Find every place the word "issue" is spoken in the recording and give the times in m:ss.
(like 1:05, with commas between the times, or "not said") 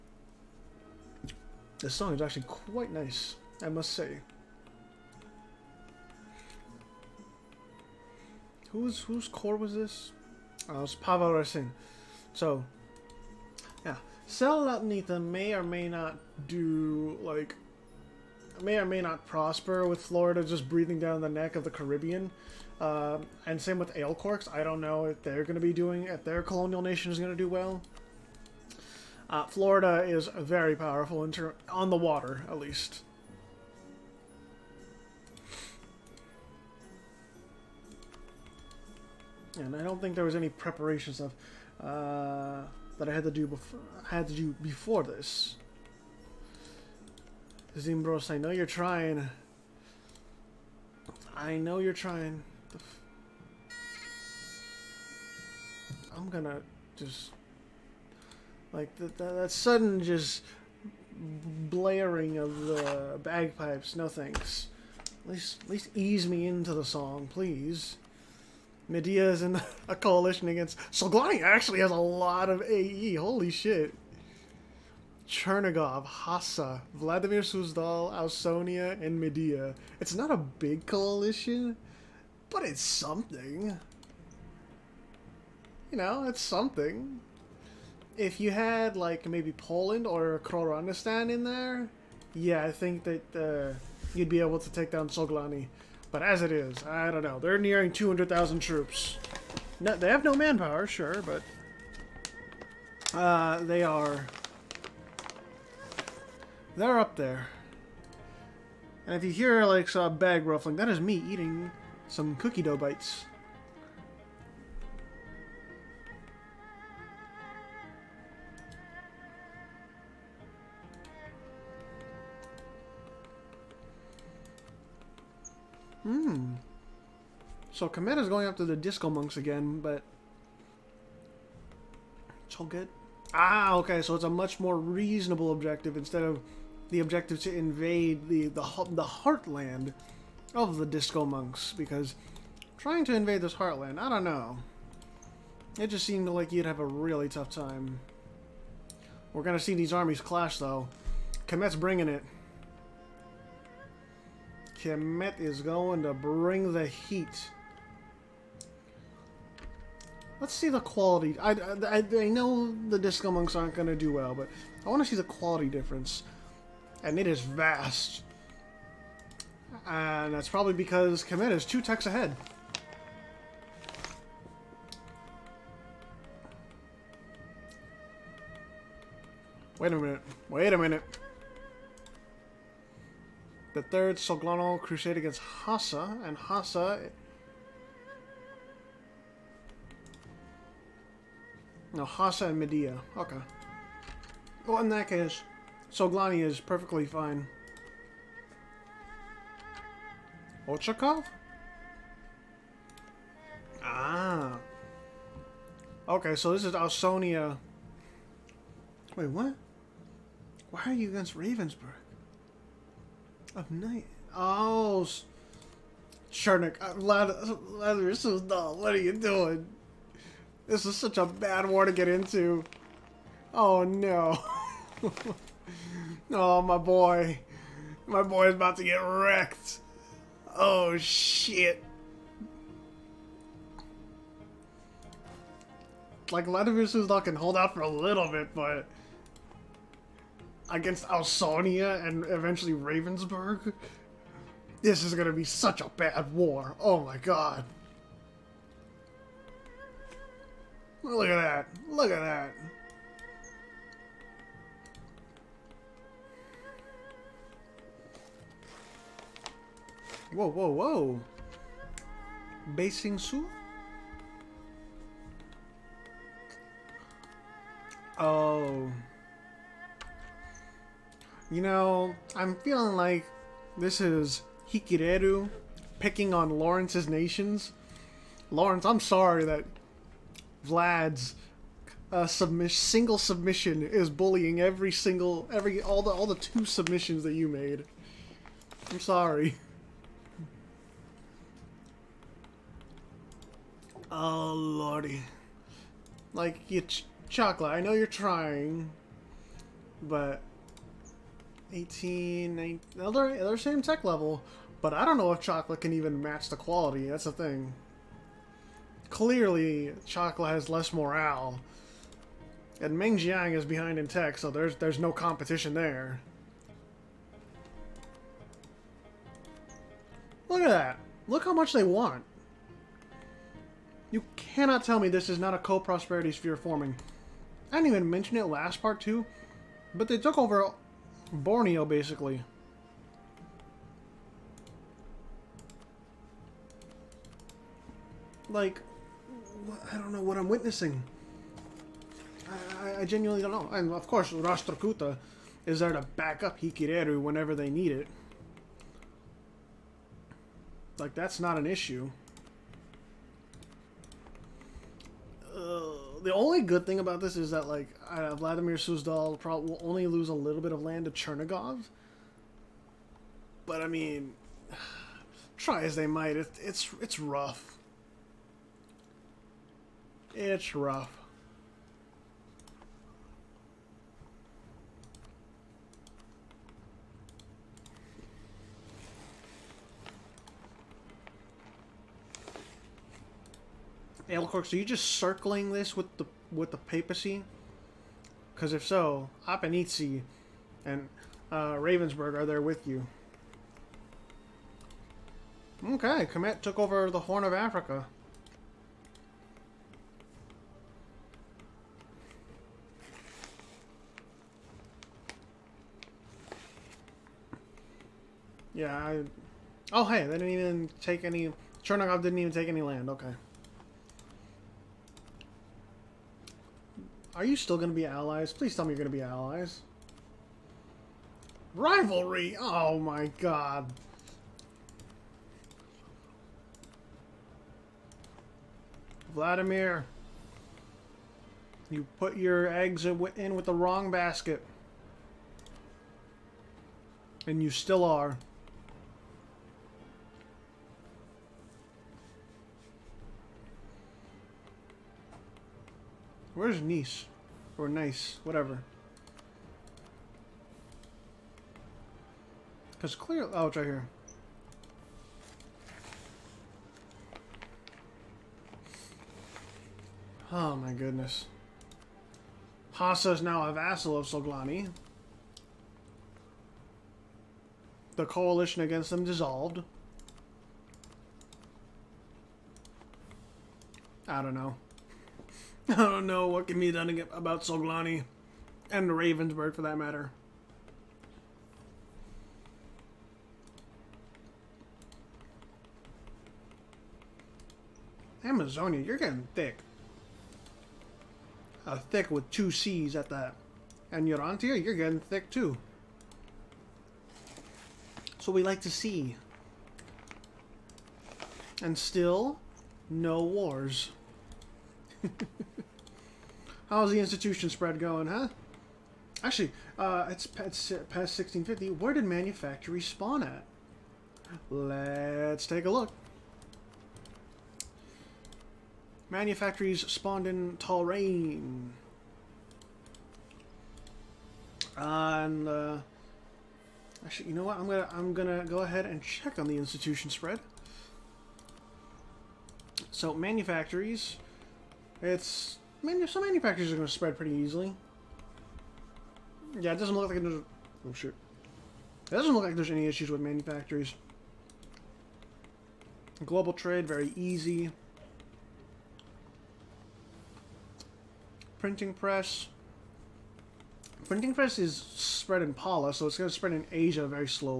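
5:51, 9:03.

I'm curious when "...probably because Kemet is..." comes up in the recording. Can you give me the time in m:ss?
2:50.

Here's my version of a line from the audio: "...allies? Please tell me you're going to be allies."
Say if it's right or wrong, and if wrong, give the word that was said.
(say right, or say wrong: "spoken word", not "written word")
right.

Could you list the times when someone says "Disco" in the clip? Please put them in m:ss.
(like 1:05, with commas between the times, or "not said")
2:08, 2:20, 2:42.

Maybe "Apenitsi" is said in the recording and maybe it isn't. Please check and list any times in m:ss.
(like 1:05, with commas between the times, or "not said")
6:29.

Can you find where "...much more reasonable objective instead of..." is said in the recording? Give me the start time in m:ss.
2:14.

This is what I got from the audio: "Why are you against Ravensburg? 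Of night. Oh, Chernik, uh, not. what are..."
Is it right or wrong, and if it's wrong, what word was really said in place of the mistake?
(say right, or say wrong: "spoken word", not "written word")
right.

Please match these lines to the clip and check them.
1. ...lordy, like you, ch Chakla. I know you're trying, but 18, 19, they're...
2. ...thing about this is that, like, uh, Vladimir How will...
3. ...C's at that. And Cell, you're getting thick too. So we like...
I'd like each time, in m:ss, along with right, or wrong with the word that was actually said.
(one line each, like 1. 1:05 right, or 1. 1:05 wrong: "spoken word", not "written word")
1. 4:54 right
2. 5:56 wrong: "Suzdal", not "How"
3. 8:12 wrong: "Yorantia", not "Cell".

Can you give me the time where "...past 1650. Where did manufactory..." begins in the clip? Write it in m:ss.
8:30.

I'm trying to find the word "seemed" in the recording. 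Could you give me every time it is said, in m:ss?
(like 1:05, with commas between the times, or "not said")
2:26.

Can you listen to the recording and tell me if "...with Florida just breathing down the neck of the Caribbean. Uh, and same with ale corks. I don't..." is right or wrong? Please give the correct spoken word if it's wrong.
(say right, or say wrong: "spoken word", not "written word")
right.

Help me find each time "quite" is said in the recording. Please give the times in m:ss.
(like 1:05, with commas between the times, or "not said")
0:02.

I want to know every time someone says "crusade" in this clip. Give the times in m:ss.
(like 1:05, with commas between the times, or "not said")
3:04.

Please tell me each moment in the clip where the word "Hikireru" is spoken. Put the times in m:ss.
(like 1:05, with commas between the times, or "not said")
4:34, 5:46.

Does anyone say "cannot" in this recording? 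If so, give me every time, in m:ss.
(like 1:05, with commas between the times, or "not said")
5:24.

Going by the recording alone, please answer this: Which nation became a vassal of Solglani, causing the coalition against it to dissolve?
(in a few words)
Hasa.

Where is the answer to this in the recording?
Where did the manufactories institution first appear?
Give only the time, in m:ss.
8:40.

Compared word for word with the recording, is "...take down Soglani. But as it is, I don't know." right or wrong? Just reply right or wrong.
right.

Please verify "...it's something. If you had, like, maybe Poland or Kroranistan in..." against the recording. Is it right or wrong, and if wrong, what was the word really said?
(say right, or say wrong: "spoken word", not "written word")
right.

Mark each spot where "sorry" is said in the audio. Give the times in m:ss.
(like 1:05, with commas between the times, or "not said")
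4:39, 4:49.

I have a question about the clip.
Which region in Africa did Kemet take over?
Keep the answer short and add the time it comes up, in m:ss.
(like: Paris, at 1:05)
Horn of Africa, at 6:37.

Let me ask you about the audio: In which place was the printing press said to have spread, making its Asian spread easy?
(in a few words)
Pala.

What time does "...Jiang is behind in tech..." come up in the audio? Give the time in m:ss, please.
5:13.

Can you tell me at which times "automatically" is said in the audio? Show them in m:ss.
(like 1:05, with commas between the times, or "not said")
not said.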